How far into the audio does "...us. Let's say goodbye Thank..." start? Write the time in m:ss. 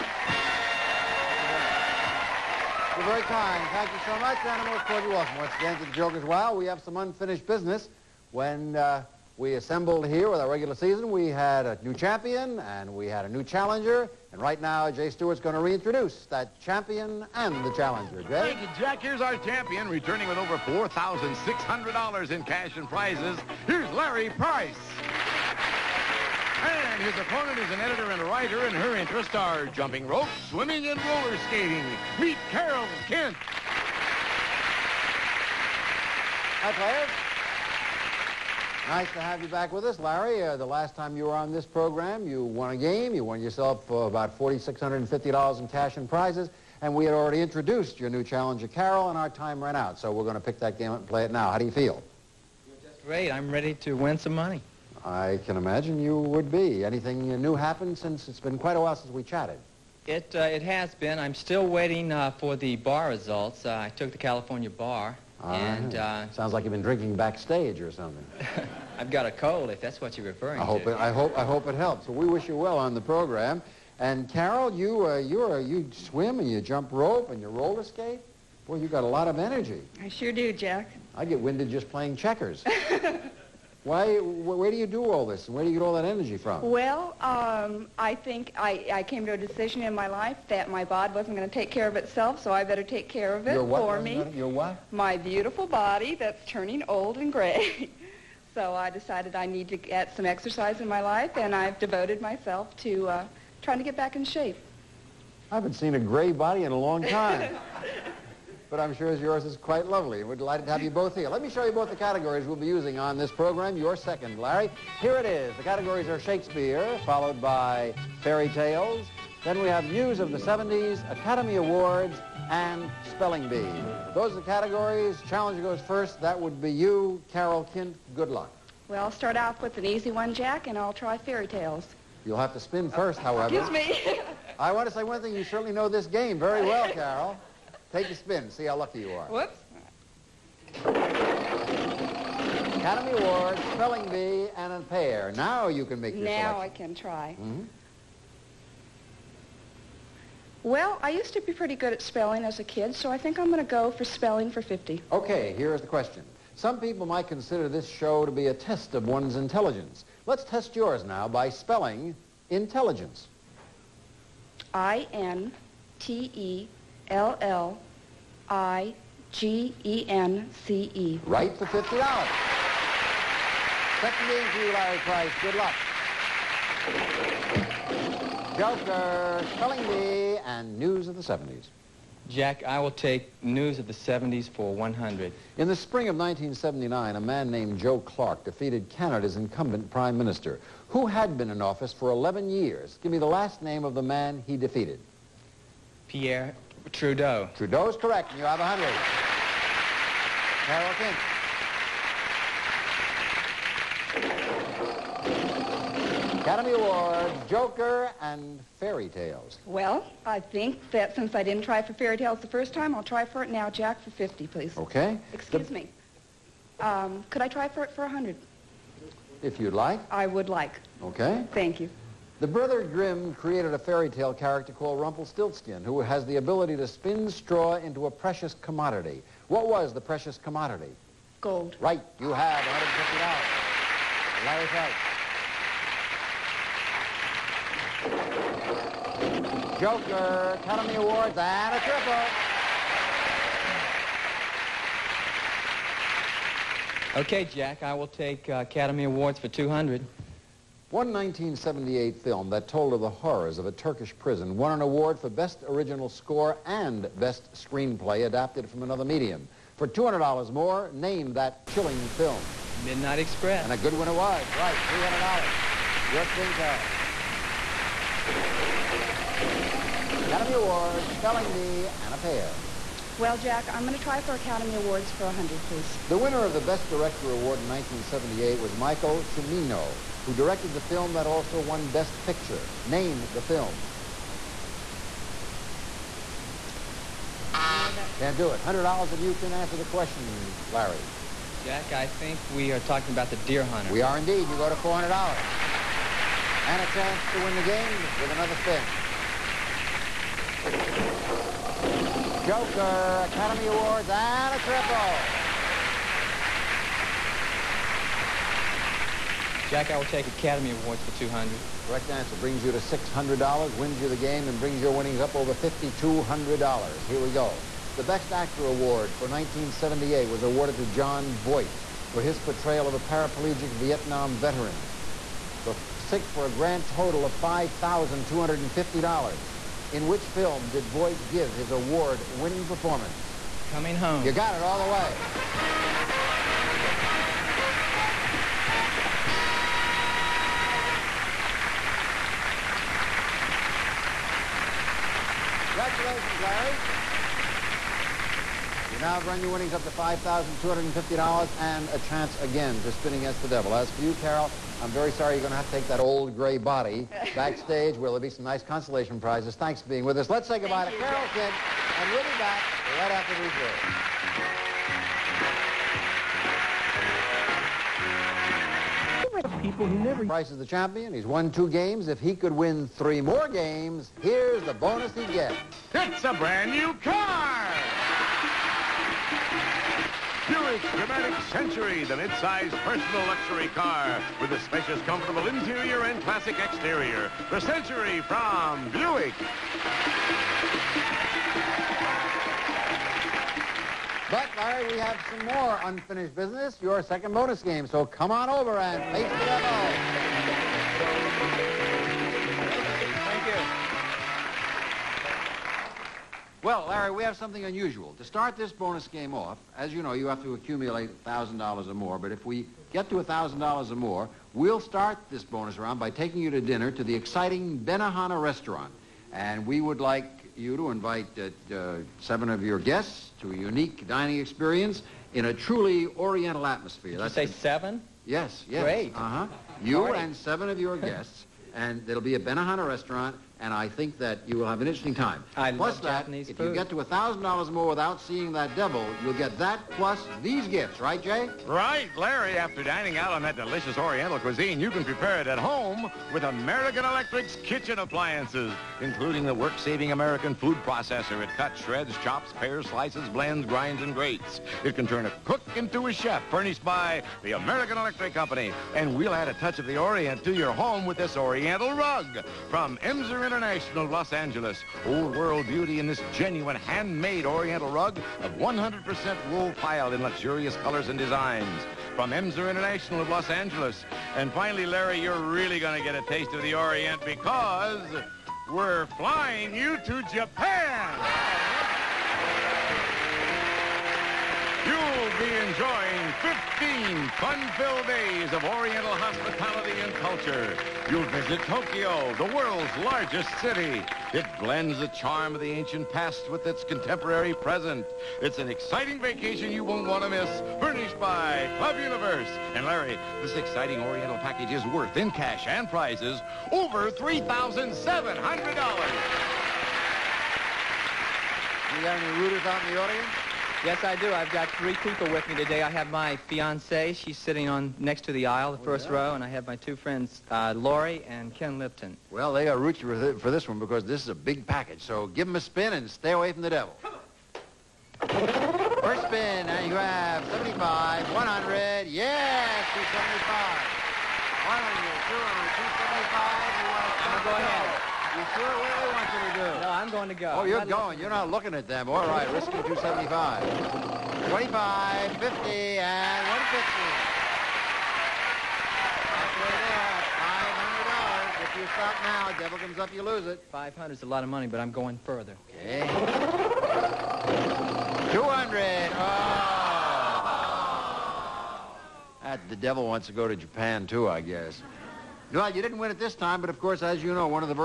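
6:00.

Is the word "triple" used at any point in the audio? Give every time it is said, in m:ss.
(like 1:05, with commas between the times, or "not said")
4:01, 5:04.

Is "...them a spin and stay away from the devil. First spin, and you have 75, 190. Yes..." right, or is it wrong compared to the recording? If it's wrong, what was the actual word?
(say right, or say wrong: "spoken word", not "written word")
wrong: "100", not "190".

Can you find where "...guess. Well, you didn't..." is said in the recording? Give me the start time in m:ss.
9:24.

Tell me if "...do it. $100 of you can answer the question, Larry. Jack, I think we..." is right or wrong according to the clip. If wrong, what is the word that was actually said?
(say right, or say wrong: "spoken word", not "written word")
right.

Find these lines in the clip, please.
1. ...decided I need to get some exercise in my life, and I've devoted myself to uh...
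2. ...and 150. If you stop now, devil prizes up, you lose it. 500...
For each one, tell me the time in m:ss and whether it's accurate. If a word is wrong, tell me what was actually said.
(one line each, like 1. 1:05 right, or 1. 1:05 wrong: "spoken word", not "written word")
1. 1:38 right
2. 9:05 wrong: "comes", not "prizes".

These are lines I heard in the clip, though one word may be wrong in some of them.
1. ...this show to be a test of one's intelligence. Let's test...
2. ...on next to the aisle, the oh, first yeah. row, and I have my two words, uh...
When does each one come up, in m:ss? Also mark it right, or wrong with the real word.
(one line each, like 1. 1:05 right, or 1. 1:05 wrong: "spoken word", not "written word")
1. 2:37 right
2. 8:37 wrong: "friends", not "words".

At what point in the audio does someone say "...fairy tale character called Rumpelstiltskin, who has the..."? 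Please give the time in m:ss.
3:43.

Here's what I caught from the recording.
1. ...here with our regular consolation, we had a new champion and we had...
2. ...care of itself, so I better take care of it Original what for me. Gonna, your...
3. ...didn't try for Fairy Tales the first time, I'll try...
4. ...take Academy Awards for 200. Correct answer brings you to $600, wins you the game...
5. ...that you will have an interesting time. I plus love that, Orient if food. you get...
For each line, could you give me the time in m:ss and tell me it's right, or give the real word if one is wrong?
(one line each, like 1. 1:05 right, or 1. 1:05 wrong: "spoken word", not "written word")
1. 0:10 wrong: "season", not "consolation"
2. 1:31 wrong: "Your", not "Original"
3. 3:31 right
4. 5:10 right
5. 7:14 wrong: "Japanese", not "Orient".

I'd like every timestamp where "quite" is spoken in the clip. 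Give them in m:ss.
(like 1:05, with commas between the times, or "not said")
0:58, 1:49.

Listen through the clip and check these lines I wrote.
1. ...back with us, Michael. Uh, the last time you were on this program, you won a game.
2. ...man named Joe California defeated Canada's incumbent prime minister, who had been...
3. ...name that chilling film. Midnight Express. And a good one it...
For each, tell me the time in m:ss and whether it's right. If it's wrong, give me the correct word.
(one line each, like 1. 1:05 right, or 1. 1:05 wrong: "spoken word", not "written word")
1. 0:39 wrong: "Larry", not "Michael"
2. 3:07 wrong: "Clark", not "California"
3. 4:20 right.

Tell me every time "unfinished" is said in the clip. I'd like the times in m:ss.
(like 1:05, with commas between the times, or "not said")
0:06, 6:35.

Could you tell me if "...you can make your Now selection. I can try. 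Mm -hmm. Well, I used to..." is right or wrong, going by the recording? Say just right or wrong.
right.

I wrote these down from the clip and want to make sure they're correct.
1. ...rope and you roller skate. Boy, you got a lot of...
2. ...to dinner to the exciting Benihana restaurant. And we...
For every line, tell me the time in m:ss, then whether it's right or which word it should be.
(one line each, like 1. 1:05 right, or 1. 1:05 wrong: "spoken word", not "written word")
1. 1:16 right
2. 6:56 right.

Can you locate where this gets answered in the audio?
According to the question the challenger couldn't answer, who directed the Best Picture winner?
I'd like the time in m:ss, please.
4:38.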